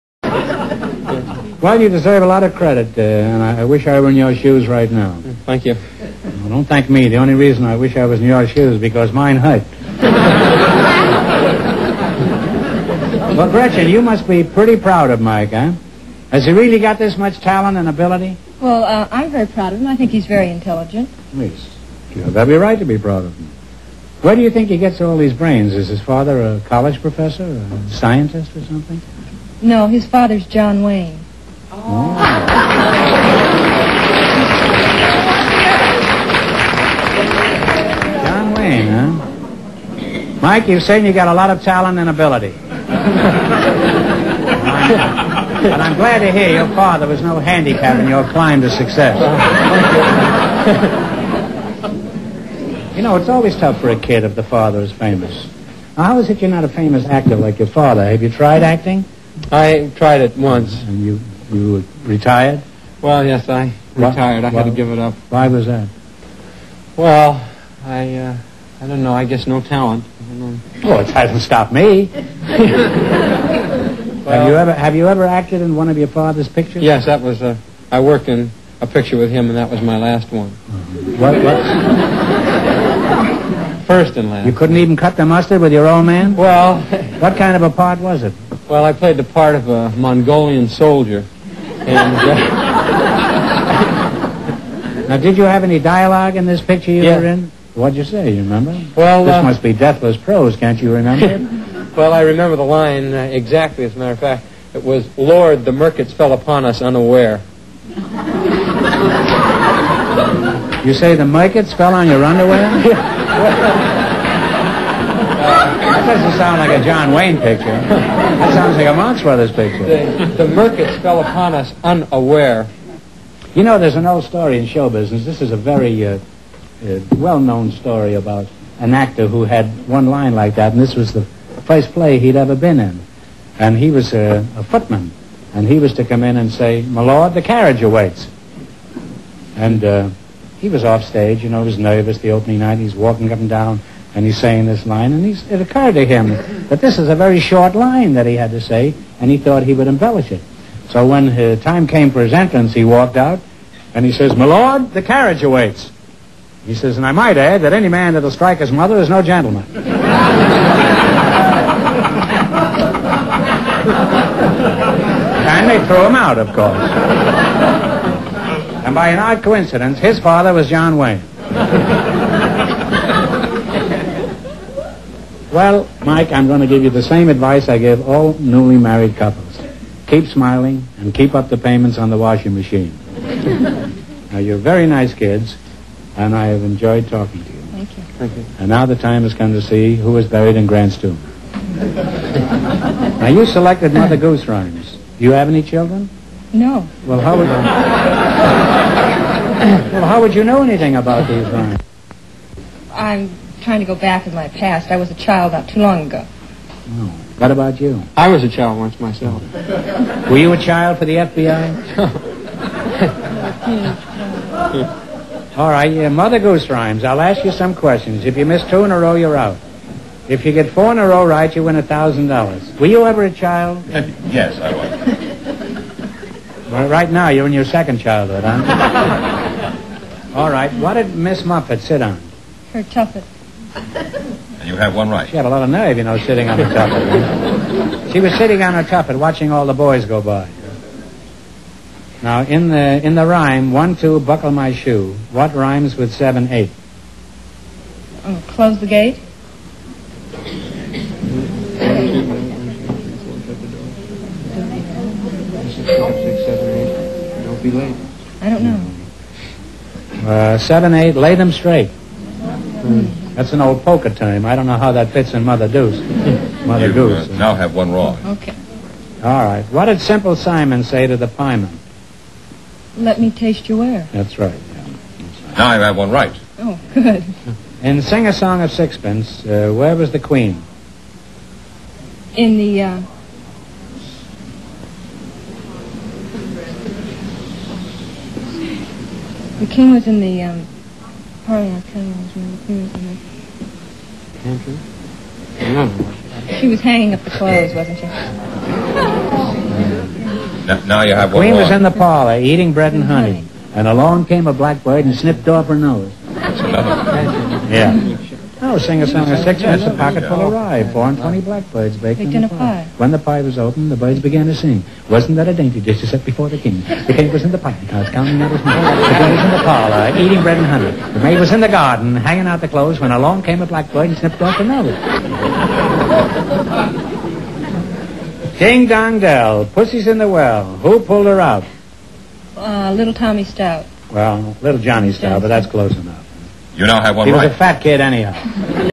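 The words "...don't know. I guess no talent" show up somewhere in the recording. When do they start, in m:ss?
1:08.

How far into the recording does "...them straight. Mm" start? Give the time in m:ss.
4:21.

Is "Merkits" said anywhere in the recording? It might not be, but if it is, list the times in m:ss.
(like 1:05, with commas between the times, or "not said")
1:45, 1:51, 2:00.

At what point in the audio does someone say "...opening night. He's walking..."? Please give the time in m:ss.
2:22.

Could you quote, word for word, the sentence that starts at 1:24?
You couldn't even cut the mustard with your old man.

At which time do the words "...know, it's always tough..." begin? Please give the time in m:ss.
0:53.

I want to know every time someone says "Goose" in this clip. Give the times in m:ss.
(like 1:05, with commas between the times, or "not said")
3:14, 3:36, 4:26.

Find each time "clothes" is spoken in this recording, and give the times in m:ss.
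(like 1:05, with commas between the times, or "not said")
4:57, 5:22.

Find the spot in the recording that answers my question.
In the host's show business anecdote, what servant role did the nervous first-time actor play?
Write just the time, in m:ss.
2:14.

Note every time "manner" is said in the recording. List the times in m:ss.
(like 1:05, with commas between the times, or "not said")
not said.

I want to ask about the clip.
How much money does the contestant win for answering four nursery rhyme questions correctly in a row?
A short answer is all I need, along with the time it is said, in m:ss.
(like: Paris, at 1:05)
$1,000, at 3:41.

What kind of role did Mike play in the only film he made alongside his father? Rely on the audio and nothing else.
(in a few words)
Mongolian soldier.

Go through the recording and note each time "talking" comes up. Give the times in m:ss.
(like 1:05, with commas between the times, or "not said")
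3:07.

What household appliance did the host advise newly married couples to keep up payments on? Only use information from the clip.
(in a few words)
washing machine.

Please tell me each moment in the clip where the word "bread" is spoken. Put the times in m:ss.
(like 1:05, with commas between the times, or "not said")
5:02, 5:20.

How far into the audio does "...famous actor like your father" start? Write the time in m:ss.
0:56.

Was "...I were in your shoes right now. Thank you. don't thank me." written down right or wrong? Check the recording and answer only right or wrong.
right.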